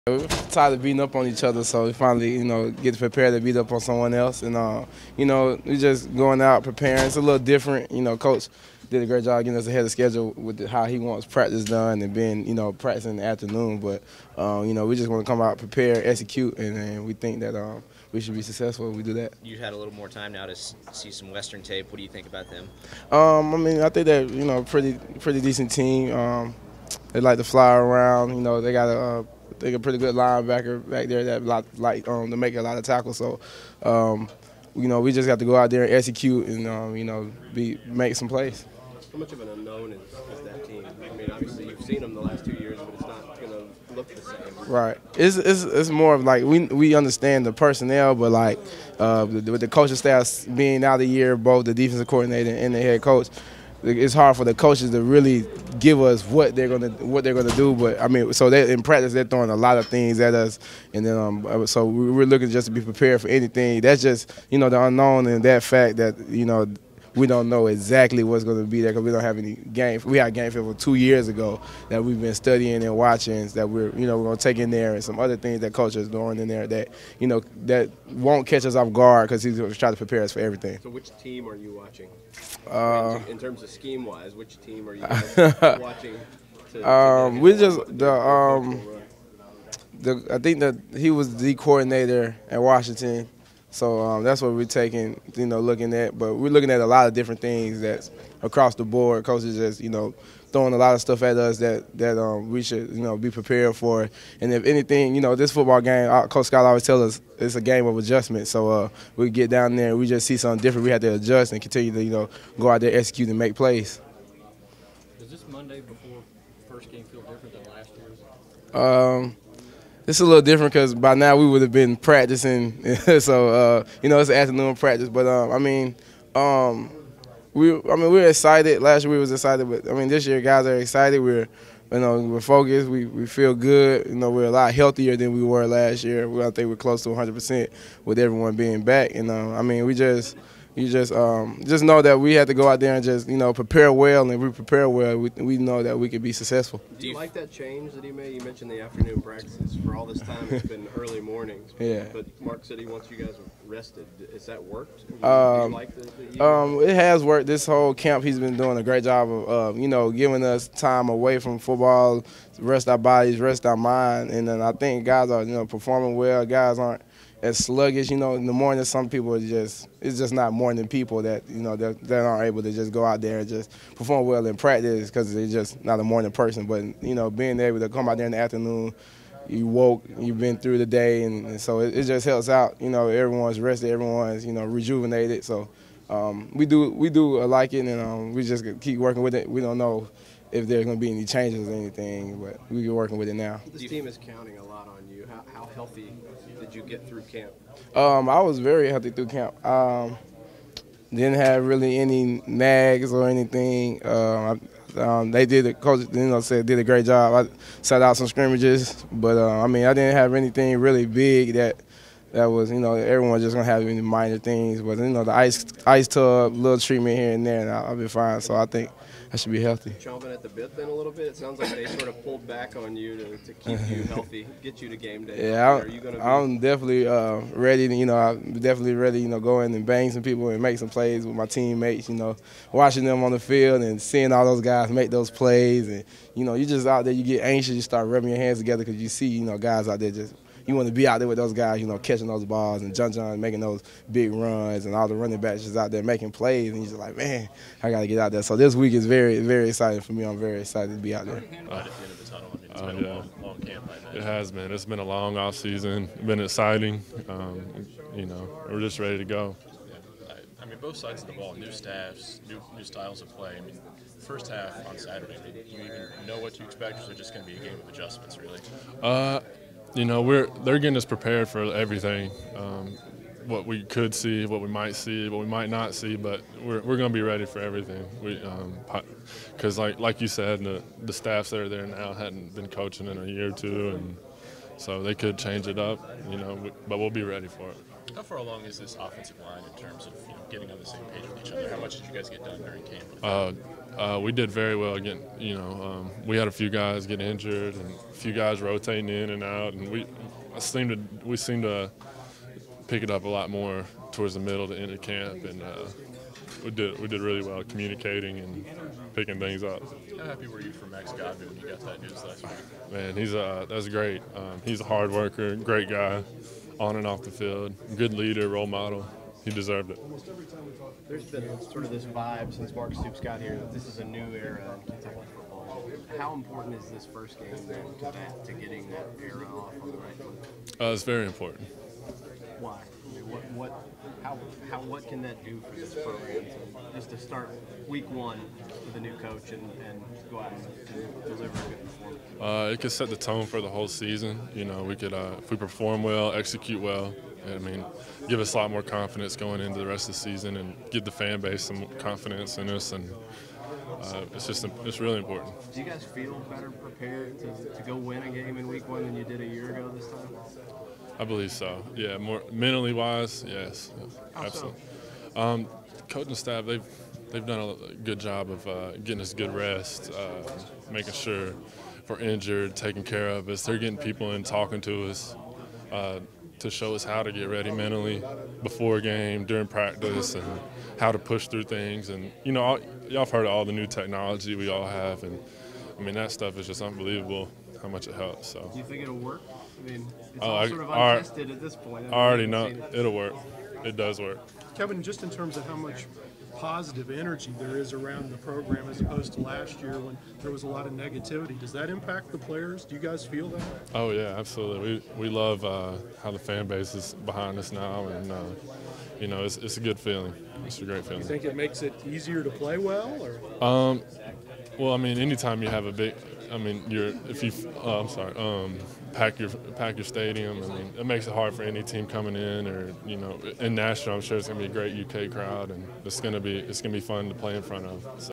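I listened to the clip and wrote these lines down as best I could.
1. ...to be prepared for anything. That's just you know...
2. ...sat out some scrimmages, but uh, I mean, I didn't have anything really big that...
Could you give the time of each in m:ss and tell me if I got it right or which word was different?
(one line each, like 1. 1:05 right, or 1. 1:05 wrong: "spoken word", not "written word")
1. 1:02 right
2. 3:27 right.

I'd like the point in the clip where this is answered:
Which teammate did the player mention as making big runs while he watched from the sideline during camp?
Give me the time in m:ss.
4:02.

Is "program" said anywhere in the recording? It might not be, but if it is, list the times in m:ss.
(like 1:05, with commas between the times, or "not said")
5:35, 6:38.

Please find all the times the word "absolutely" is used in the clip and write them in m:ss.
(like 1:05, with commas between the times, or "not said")
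6:04, 6:44.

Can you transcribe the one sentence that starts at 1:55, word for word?
Does this Monday before first game feel different than last year's?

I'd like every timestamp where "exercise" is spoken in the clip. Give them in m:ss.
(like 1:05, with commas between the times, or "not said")
not said.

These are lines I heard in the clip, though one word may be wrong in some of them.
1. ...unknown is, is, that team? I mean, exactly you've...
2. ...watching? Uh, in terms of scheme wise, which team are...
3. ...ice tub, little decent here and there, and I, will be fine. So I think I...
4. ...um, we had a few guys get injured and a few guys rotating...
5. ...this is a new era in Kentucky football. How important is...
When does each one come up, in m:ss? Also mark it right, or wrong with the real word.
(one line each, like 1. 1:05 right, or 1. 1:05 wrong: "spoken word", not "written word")
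1. 0:39 wrong: "obviously", not "exactly"
2. 1:21 right
3. 3:35 wrong: "treatment", not "decent"
4. 4:55 right
5. 5:23 right.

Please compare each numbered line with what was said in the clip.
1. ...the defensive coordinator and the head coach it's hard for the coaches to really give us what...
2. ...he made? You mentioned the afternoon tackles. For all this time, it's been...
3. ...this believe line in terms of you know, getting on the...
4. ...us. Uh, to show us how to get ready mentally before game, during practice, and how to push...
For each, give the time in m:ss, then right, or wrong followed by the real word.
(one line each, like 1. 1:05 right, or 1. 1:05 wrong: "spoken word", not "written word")
1. 0:51 right
2. 2:28 wrong: "practices", not "tackles"
3. 4:48 wrong: "offensive", not "believe"
4. 6:15 right.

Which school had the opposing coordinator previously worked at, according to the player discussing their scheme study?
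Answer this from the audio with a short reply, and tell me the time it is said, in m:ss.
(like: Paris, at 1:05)
Washington, at 1:32.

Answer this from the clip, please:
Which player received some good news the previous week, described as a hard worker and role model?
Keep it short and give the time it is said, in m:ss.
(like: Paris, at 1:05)
Max Godwin, at 5:10.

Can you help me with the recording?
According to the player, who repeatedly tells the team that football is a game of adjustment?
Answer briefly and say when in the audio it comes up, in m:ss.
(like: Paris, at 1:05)
Coach Scott, at 1:46.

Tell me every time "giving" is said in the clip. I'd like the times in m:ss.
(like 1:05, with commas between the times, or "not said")
2:40.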